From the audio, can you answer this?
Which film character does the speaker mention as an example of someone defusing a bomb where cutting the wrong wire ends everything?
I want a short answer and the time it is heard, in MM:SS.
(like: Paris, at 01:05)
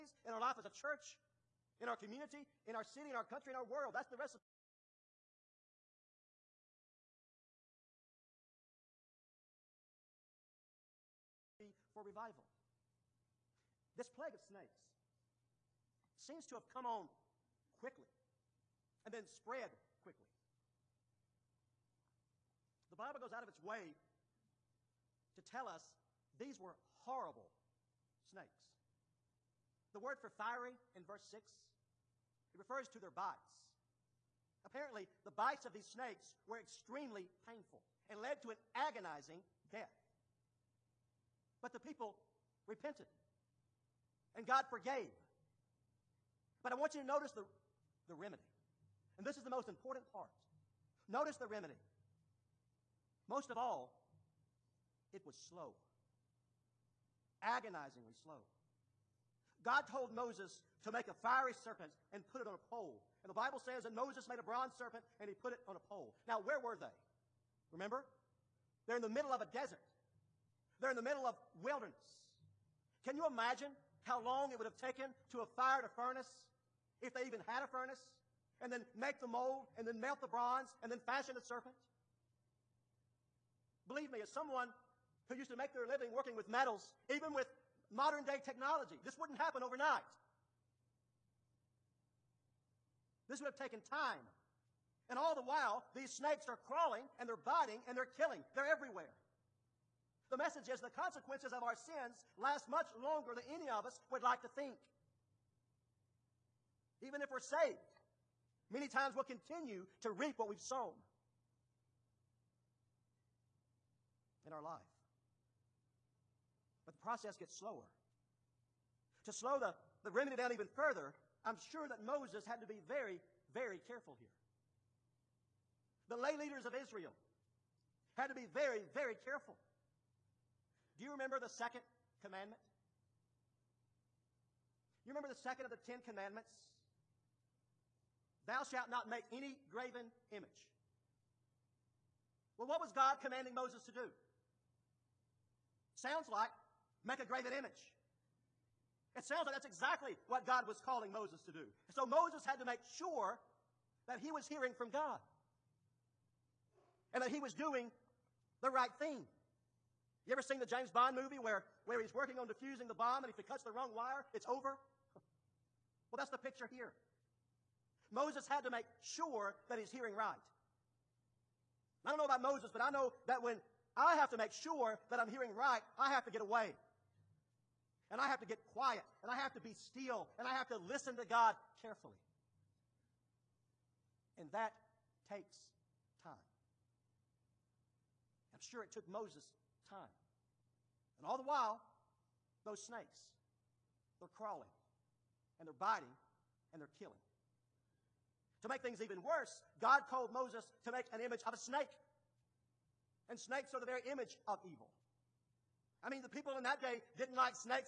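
James Bond, at 02:40.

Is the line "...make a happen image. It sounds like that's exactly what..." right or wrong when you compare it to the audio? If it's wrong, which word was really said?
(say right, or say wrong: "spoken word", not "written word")
wrong: "graven", not "happen".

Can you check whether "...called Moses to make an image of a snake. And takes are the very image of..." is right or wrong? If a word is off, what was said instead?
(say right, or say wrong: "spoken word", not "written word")
wrong: "snakes", not "takes".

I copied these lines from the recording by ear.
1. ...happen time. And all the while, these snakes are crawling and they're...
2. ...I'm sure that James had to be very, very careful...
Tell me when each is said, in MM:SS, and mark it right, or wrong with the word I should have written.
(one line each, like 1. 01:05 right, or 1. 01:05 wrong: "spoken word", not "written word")
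1. 01:33 wrong: "taken", not "happen"
2. 02:01 wrong: "Moses", not "James".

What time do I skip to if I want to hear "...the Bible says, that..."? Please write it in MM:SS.
01:03.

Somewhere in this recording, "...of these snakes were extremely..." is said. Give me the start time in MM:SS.
00:35.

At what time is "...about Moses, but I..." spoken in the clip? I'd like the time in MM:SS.
02:52.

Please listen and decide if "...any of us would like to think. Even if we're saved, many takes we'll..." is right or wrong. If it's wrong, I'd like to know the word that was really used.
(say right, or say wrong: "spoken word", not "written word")
wrong: "times", not "takes".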